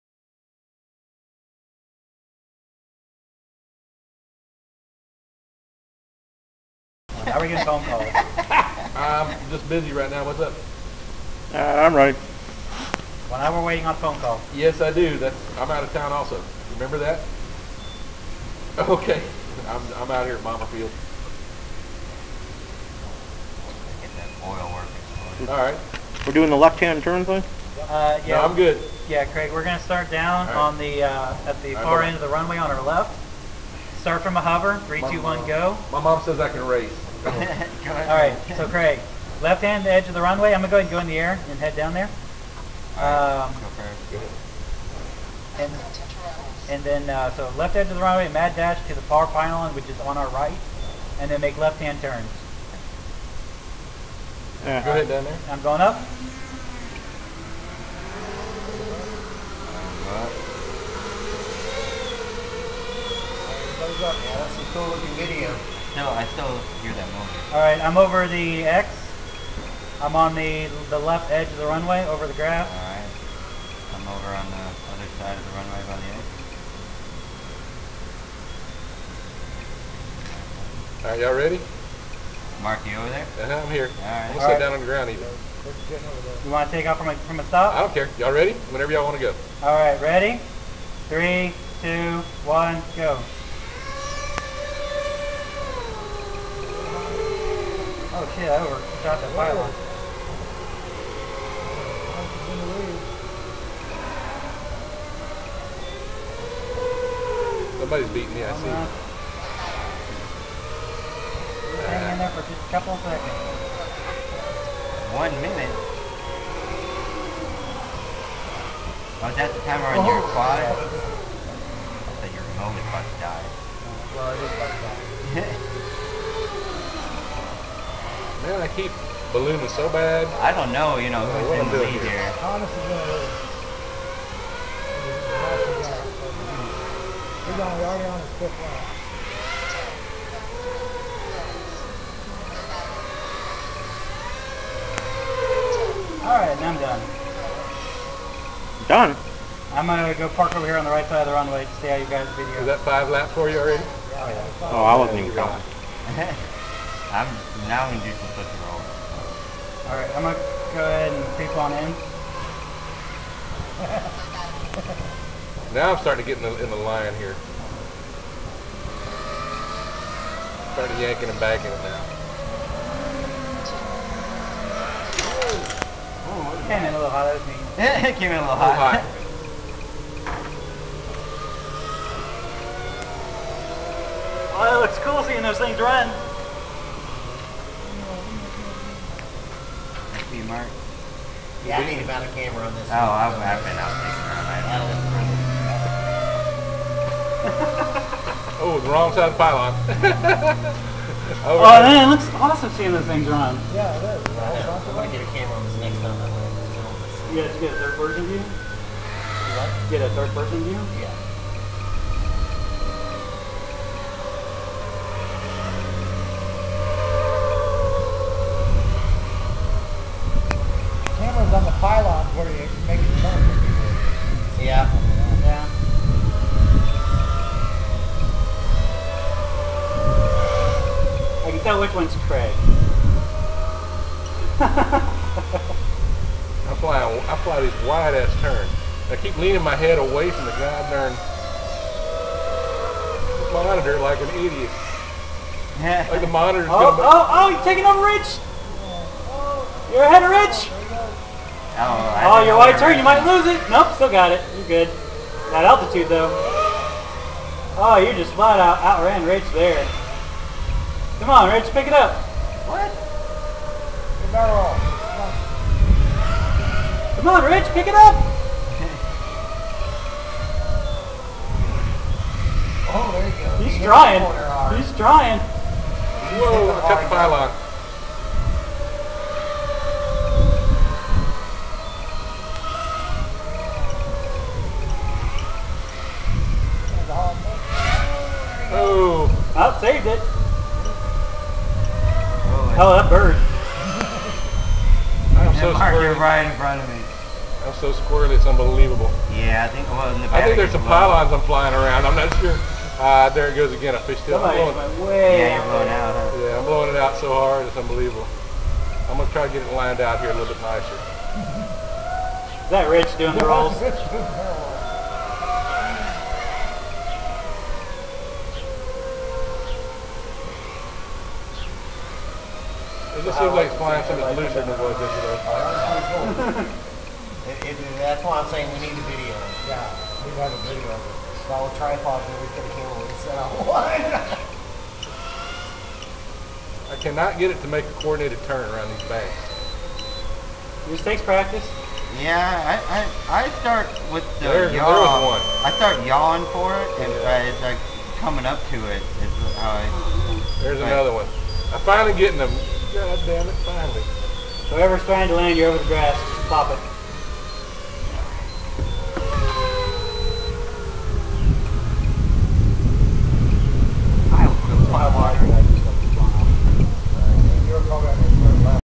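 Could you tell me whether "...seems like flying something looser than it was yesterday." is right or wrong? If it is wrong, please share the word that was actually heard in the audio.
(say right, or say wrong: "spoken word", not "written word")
right.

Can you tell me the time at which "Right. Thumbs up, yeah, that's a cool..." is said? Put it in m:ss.
1:00.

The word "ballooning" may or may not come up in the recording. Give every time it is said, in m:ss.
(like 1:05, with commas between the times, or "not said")
2:09.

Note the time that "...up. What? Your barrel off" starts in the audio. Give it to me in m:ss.
4:21.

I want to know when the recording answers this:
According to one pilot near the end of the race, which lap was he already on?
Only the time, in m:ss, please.
2:18.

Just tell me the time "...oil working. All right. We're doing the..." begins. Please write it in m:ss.
0:24.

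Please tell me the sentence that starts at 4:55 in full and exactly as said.
I'm so Mark, you're right in front of me.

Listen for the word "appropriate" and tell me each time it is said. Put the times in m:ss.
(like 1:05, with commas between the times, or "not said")
not said.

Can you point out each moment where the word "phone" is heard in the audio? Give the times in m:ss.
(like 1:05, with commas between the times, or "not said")
0:07, 0:13.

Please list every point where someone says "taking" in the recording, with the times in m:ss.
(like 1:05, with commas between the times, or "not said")
3:14, 4:07.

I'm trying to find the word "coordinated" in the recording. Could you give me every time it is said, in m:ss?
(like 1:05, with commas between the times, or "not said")
5:38.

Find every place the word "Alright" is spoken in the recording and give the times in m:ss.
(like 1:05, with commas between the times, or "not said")
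2:26, 2:39.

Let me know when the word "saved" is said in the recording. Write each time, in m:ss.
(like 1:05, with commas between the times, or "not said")
4:49.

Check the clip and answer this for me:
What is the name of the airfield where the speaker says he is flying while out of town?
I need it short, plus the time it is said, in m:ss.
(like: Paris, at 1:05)
Bomber Field, at 0:20.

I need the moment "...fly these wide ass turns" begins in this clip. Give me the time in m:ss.
3:57.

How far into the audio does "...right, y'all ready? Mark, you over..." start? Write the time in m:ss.
1:21.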